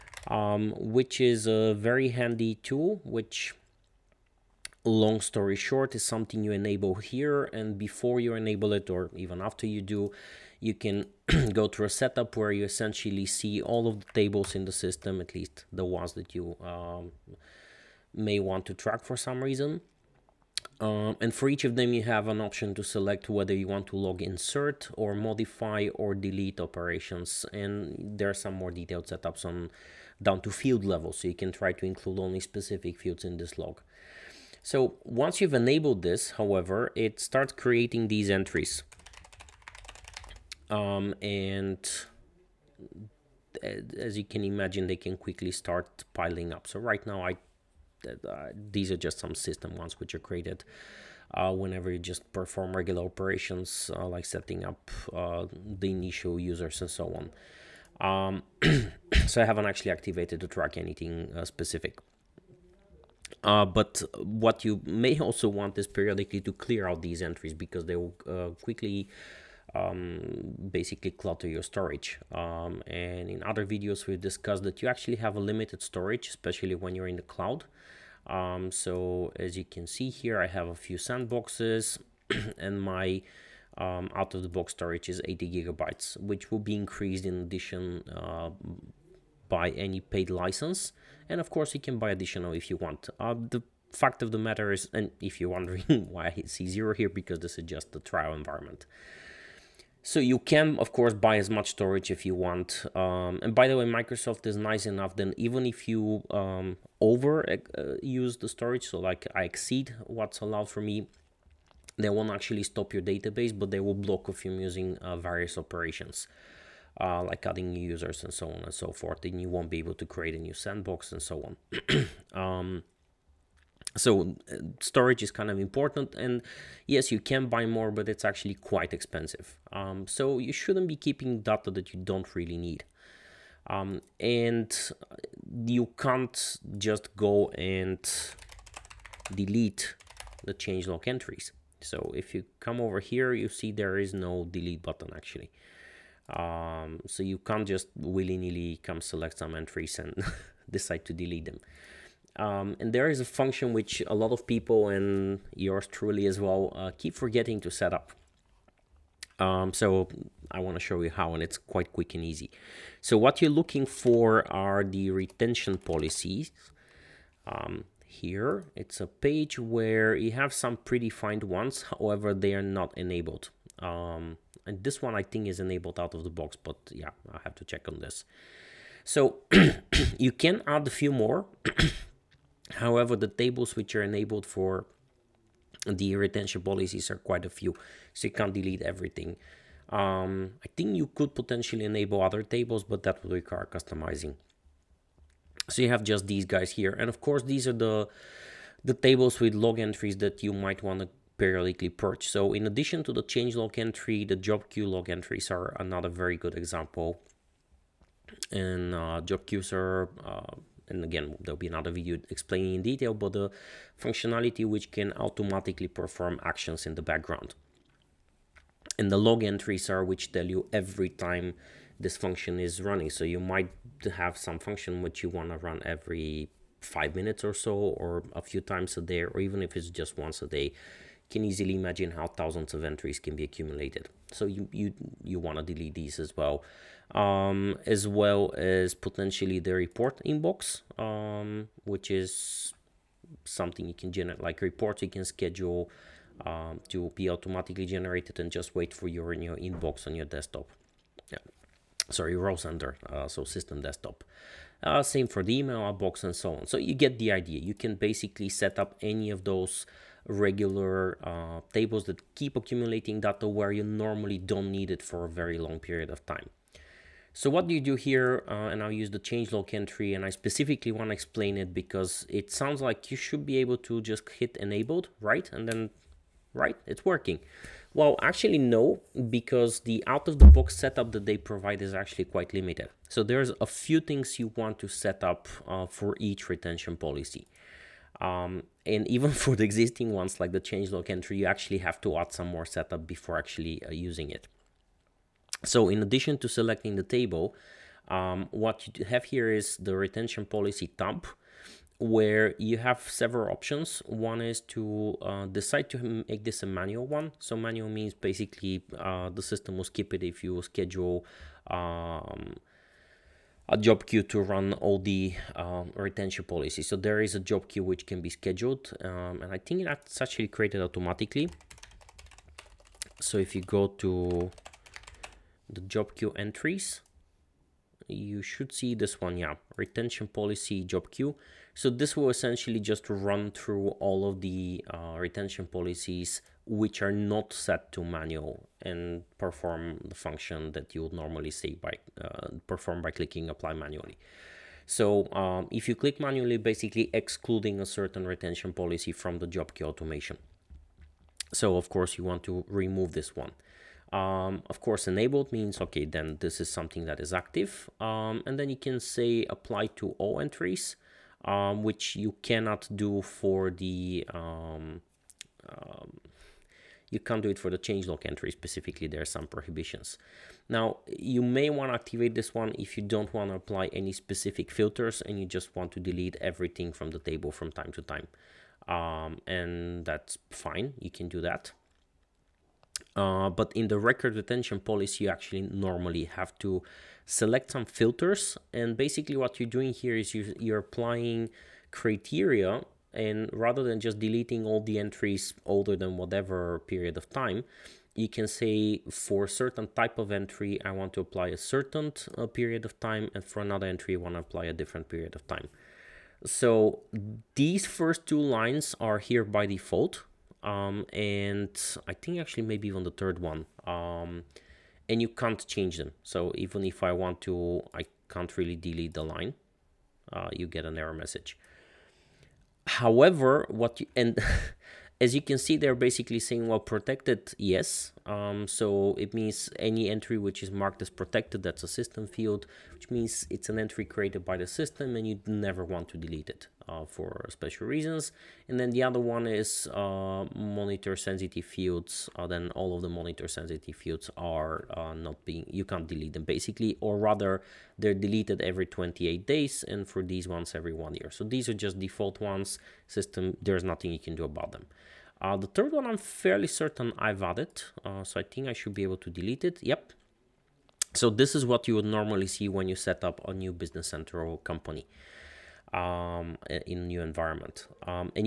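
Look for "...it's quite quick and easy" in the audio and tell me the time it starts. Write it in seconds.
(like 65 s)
161 s.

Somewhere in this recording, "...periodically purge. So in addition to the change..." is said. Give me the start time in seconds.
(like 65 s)
201 s.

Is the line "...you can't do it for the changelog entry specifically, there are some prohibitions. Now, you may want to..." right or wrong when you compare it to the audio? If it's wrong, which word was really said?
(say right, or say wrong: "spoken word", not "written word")
right.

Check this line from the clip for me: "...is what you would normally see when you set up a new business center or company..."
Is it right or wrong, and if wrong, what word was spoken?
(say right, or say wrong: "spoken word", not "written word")
right.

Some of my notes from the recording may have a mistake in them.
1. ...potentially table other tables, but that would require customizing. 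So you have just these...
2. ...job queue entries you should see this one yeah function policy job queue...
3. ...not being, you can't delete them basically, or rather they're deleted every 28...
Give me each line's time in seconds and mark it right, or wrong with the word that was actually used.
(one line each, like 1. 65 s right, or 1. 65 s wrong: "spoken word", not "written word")
1. 191 s wrong: "enable", not "table"
2. 325 s wrong: "retention", not "function"
3. 445 s right.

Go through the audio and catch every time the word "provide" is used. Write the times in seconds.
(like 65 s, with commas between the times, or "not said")
281 s.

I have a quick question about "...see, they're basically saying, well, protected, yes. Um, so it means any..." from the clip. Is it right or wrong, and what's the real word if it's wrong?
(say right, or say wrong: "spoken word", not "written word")
right.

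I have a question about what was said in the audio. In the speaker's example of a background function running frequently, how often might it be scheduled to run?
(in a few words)
every five minutes.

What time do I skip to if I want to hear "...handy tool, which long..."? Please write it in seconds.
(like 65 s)
2 s.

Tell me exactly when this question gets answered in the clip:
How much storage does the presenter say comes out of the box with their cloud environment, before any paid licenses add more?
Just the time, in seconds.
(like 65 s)
85 s.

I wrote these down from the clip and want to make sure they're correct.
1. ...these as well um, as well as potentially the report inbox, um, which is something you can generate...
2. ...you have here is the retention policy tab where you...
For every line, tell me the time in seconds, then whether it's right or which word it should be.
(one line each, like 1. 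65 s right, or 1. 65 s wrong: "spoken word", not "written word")
1. 235 s right
2. 298 s right.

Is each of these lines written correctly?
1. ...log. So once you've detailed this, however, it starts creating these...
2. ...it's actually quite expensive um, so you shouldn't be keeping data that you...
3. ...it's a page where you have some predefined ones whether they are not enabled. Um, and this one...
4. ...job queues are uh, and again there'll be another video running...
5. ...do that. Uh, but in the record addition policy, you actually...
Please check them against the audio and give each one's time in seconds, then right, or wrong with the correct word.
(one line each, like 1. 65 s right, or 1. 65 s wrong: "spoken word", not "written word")
1. 33 s wrong: "enabled", not "detailed"
2. 128 s right
3. 168 s wrong: "however", not "whether"
4. 209 s wrong: "explaining", not "running"
5. 381 s wrong: "retention", not "addition".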